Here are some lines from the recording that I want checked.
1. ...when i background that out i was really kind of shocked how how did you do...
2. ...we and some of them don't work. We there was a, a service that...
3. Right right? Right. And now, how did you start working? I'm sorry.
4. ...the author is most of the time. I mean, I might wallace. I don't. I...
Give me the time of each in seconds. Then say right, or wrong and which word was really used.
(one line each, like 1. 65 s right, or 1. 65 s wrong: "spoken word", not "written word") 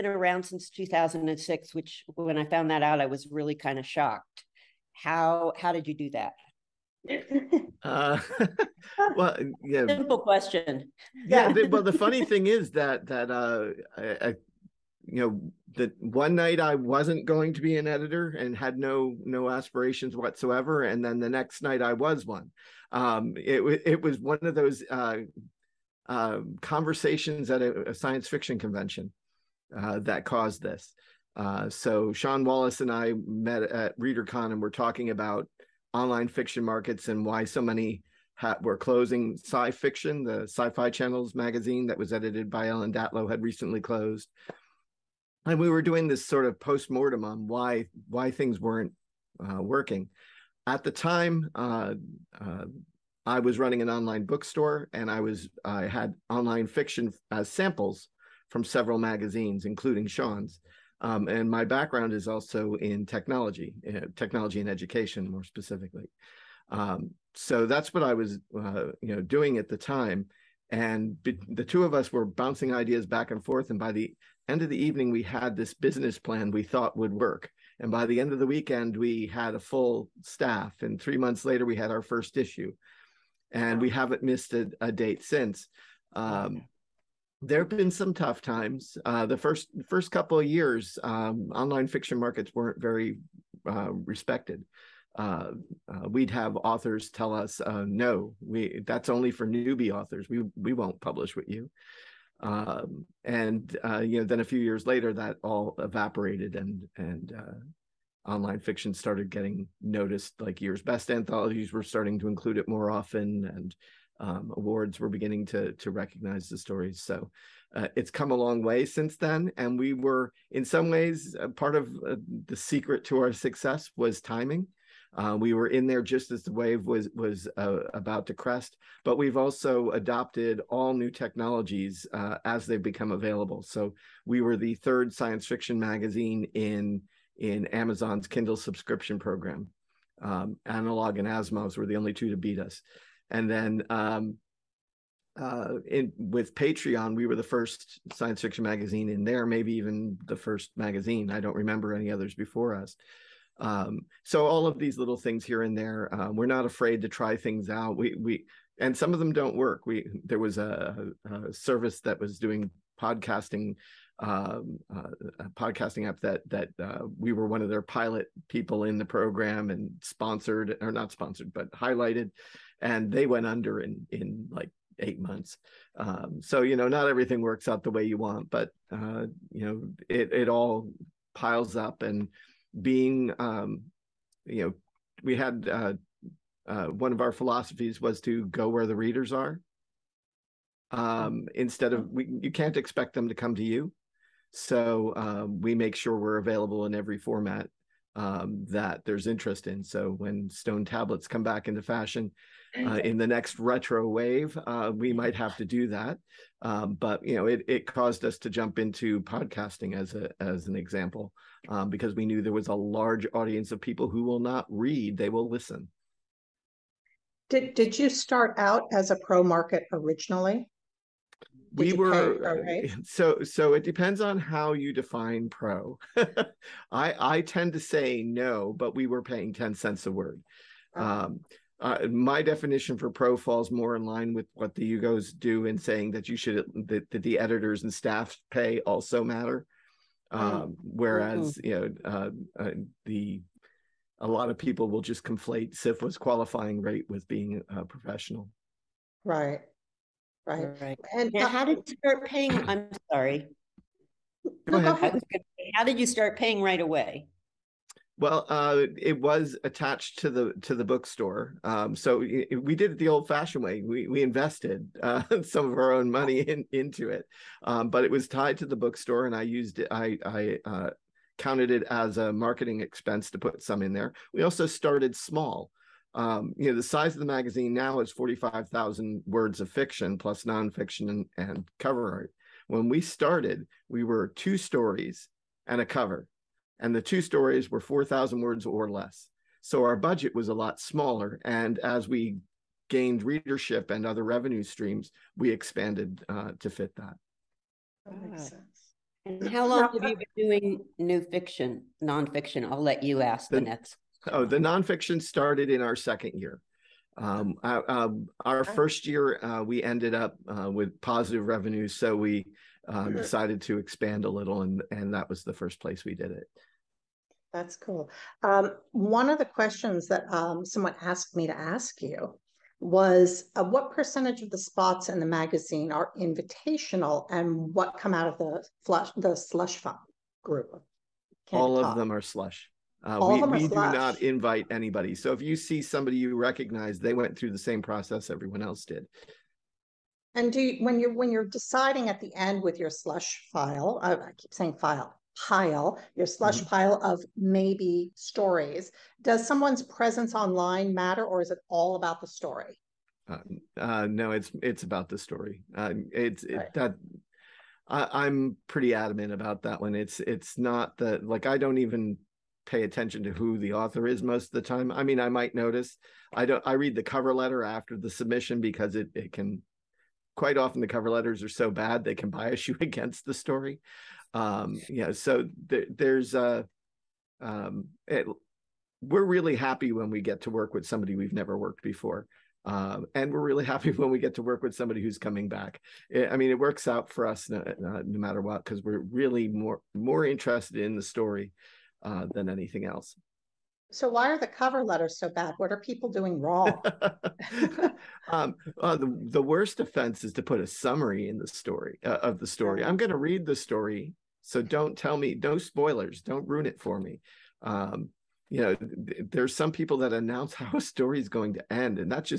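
1. 2 s wrong: "found", not "background"
2. 158 s right
3. 249 s wrong: "paying", not "working"
4. 363 s wrong: "notice", not "wallace".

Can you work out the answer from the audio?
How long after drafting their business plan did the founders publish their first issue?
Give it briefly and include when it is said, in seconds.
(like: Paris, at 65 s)
3 months, at 81 s.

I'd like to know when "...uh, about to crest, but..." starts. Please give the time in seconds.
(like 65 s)
127 s.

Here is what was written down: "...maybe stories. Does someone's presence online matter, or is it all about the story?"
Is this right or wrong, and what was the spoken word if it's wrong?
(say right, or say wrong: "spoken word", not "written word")
right.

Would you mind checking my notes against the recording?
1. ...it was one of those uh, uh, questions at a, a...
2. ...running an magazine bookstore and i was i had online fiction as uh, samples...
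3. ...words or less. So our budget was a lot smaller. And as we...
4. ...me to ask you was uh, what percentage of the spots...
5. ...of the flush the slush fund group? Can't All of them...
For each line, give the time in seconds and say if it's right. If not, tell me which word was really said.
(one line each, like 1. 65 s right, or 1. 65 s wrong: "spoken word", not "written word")
1. 23 s wrong: "conversations", not "questions"
2. 53 s wrong: "online", not "magazine"
3. 288 s right
4. 321 s right
5. 328 s right.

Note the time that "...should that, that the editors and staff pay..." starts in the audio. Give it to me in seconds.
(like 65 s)
236 s.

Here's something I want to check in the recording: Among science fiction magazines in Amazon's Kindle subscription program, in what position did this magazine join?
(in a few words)
third.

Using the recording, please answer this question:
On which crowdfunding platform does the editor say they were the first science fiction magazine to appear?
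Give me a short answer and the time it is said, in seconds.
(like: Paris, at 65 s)
Patreon, at 146 s.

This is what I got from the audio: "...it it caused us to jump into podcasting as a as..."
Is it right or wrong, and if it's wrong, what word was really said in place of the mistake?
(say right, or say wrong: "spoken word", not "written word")
right.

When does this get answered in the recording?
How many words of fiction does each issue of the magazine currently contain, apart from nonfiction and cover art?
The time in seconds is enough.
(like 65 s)
278 s.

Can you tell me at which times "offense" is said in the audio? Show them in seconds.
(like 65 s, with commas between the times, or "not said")
399 s.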